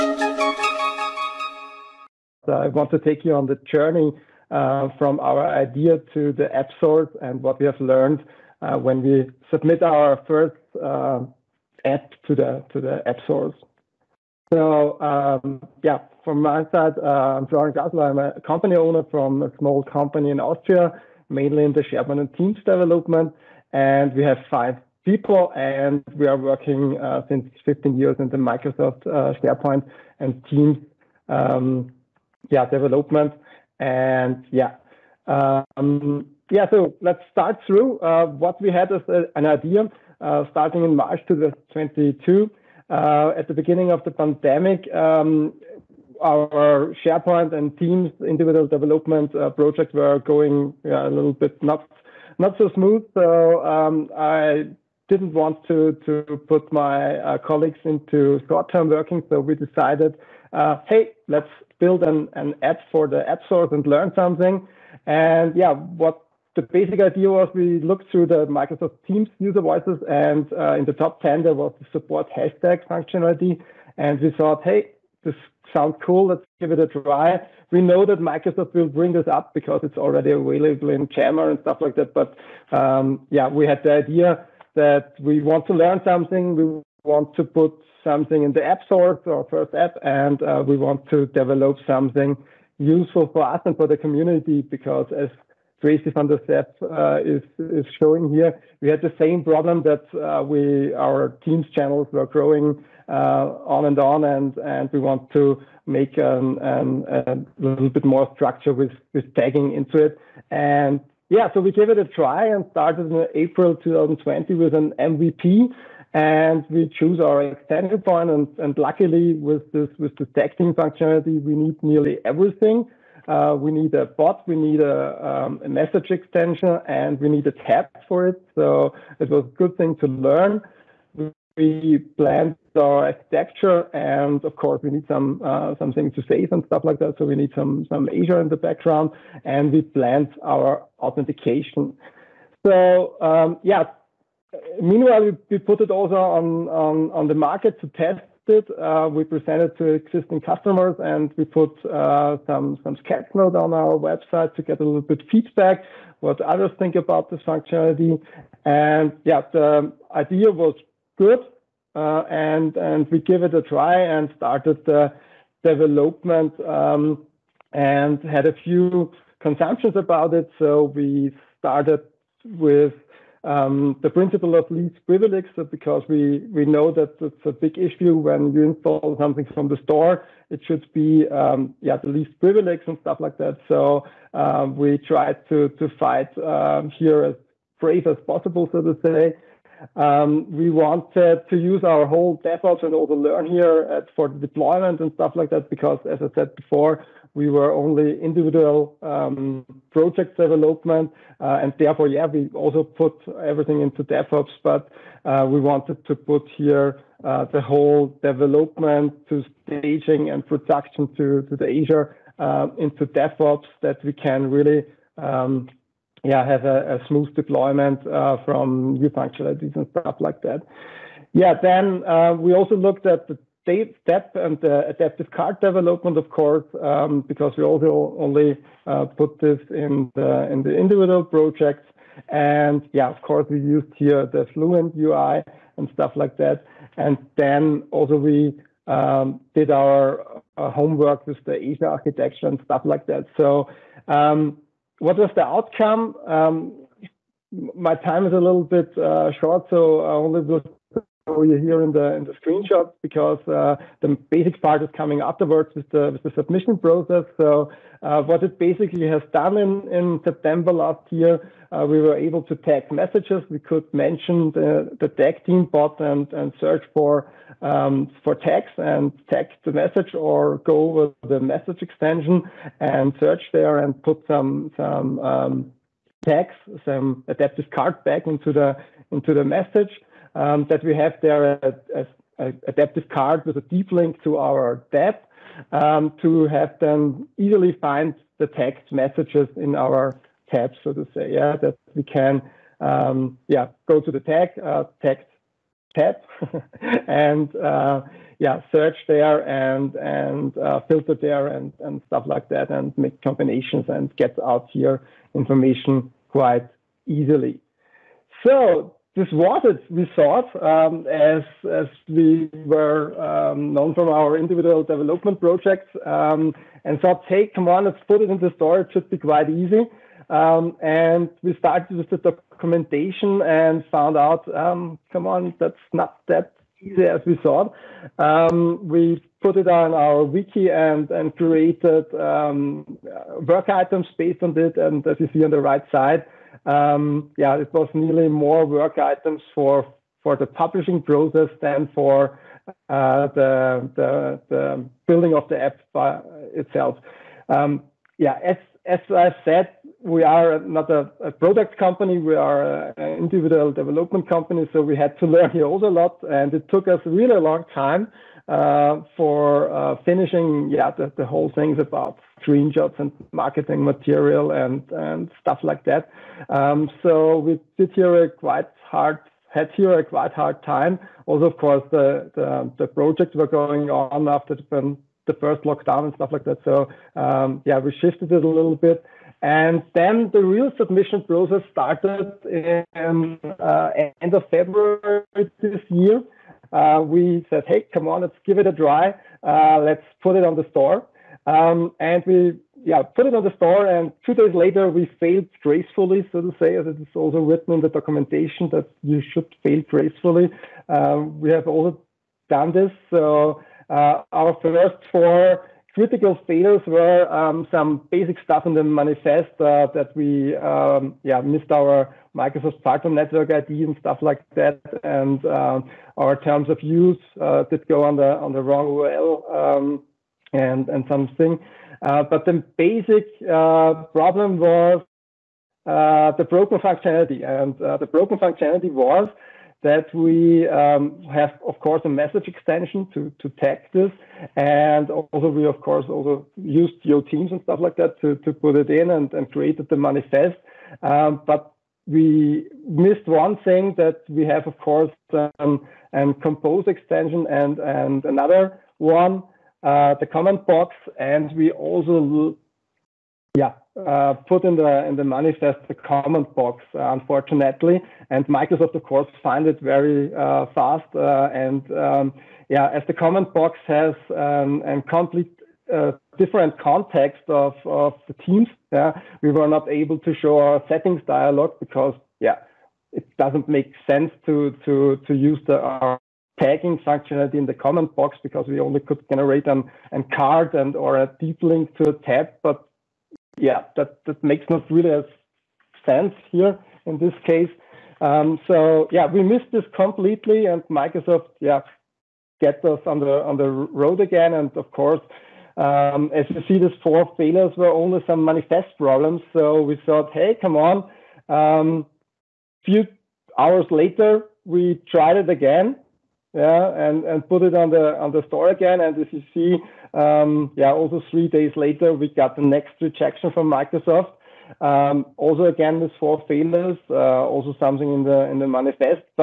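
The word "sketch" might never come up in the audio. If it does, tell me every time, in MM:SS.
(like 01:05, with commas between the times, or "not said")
02:33.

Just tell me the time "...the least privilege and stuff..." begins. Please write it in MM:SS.
03:01.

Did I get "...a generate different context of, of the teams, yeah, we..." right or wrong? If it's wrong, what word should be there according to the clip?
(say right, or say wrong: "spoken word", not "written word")
wrong: "complete", not "generate".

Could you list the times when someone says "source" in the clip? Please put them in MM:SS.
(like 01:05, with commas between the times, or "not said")
00:06, 00:13, 01:03.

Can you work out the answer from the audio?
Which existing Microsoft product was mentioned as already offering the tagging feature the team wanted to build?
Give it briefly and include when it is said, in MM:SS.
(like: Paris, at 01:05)
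Yammer, at 01:21.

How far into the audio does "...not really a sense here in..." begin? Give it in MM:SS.
08:04.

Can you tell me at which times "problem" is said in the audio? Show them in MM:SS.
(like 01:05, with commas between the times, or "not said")
01:39, 07:04, 08:18.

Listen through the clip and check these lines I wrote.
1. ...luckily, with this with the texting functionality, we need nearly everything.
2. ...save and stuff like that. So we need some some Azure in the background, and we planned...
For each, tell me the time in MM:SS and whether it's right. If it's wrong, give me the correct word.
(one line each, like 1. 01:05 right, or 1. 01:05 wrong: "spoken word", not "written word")
1. 01:58 right
2. 02:16 right.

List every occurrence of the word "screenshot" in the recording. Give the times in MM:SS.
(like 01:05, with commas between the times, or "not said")
04:12, 06:02.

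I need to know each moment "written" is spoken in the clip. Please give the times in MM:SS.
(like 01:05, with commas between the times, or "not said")
06:37.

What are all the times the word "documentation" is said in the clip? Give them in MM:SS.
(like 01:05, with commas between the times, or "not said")
05:22, 06:37.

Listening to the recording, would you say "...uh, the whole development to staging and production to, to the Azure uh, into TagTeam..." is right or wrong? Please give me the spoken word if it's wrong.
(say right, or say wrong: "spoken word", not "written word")
wrong: "DevOps", not "TagTeam".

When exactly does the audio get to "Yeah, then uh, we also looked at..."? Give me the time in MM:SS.
03:41.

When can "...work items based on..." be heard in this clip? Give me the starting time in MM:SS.
05:33.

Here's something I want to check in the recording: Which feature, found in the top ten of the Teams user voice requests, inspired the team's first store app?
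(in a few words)
hashtag functionality.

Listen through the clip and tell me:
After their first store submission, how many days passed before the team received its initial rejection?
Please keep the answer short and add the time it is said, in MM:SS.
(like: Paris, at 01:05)
2, at 06:34.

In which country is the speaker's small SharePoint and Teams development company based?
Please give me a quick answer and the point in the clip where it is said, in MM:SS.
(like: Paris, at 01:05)
Austria, at 00:20.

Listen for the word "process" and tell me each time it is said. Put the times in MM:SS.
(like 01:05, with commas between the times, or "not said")
04:16, 05:41, 06:21.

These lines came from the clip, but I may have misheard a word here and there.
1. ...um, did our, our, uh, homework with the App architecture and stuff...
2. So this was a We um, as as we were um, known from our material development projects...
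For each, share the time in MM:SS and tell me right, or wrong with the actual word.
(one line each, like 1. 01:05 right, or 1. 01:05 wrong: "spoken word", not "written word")
1. 03:58 wrong: "Azure", not "App"
2. 05:08 wrong: "individual", not "material".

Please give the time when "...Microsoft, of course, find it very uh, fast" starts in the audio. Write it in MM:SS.
07:38.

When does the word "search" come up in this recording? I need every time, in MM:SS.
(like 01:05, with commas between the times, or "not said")
04:26, 04:33, 04:58.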